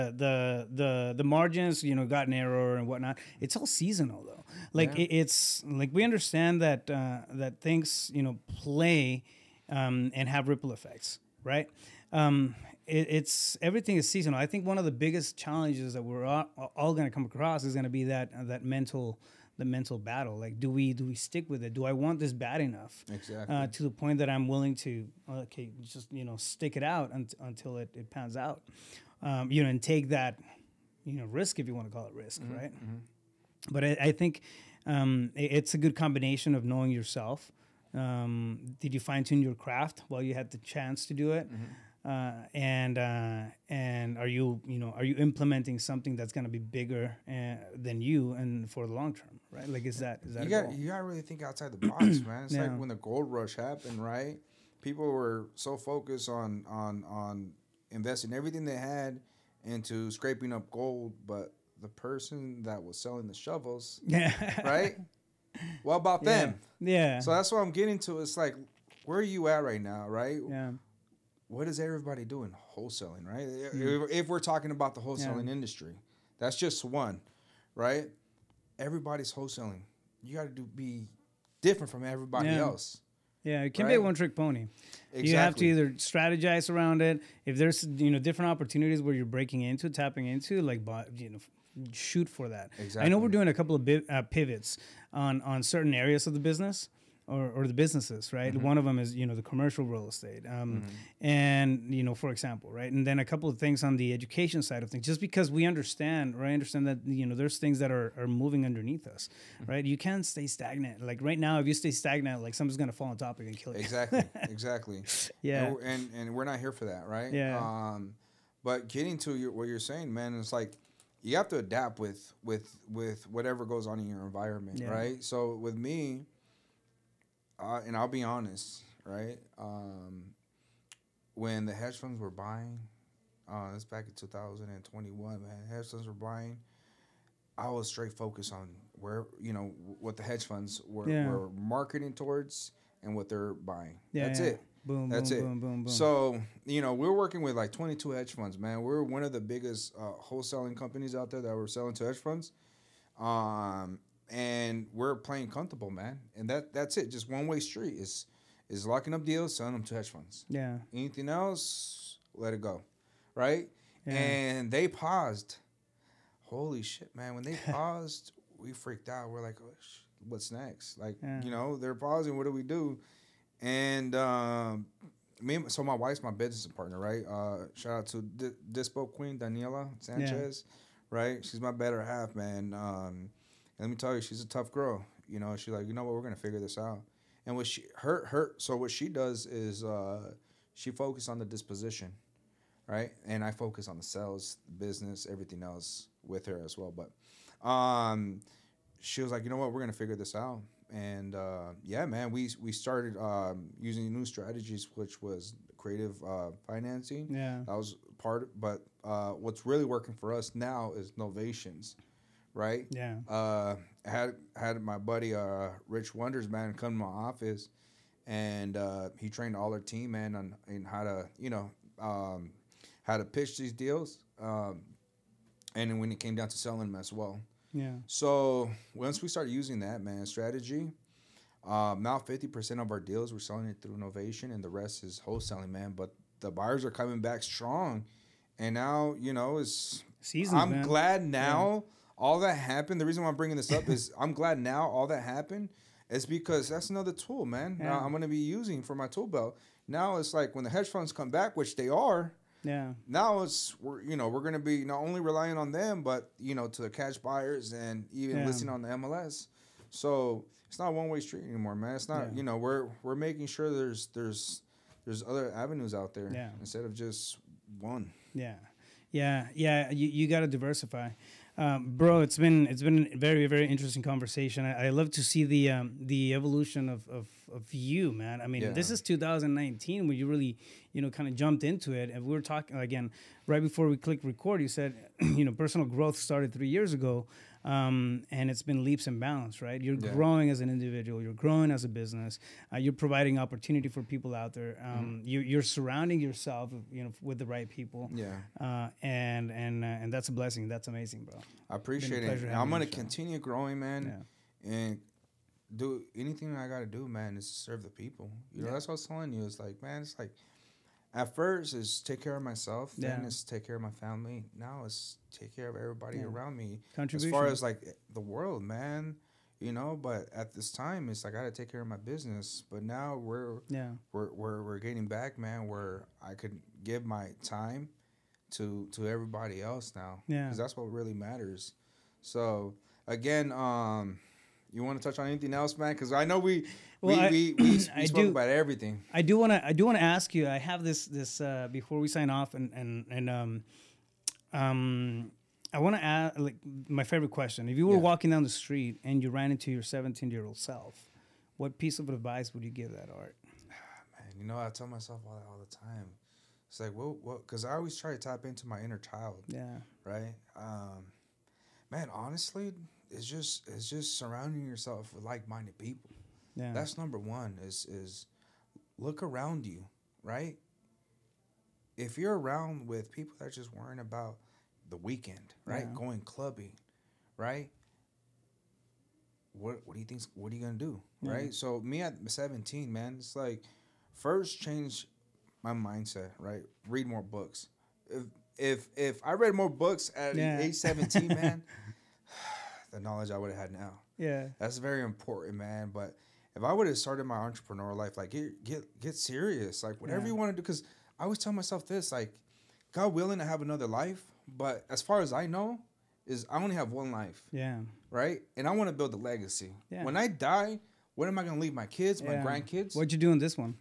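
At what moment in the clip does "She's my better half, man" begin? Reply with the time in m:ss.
3:01.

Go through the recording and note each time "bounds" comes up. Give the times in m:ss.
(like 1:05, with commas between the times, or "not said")
4:49.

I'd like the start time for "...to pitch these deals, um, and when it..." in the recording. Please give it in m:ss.
3:43.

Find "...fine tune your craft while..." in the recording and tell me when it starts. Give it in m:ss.
0:39.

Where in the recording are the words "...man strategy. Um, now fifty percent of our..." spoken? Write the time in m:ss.
3:50.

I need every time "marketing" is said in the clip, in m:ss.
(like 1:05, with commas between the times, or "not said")
2:21.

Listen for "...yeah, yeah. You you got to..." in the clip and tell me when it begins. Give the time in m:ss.
4:29.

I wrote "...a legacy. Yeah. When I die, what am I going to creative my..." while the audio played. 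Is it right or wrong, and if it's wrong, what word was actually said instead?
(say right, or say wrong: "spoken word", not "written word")
wrong: "leave", not "creative".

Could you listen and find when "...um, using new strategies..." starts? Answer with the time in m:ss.
3:23.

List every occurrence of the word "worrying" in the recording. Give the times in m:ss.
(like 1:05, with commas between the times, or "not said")
6:13.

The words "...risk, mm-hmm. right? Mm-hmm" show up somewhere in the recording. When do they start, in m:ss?
0:32.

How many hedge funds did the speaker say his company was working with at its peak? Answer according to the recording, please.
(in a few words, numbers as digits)
22.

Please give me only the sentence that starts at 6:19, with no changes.
What what do you think what are you gonna do?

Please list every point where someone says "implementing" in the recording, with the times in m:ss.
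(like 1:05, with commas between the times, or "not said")
0:45.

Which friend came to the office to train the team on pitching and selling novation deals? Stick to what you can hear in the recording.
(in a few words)
Rich Wonders.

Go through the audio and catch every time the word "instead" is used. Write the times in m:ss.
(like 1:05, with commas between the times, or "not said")
4:26.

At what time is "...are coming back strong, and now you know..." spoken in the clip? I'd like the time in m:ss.
3:56.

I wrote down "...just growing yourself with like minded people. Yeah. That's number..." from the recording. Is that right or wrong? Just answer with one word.
wrong.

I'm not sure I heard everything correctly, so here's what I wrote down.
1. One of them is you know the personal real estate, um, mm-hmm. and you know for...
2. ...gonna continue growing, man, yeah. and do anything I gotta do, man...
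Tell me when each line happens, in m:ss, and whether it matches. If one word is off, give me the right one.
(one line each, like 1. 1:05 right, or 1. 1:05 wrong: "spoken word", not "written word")
1. 1:38 wrong: "commercial", not "personal"
2. 5:02 right.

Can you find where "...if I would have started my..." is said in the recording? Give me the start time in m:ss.
6:36.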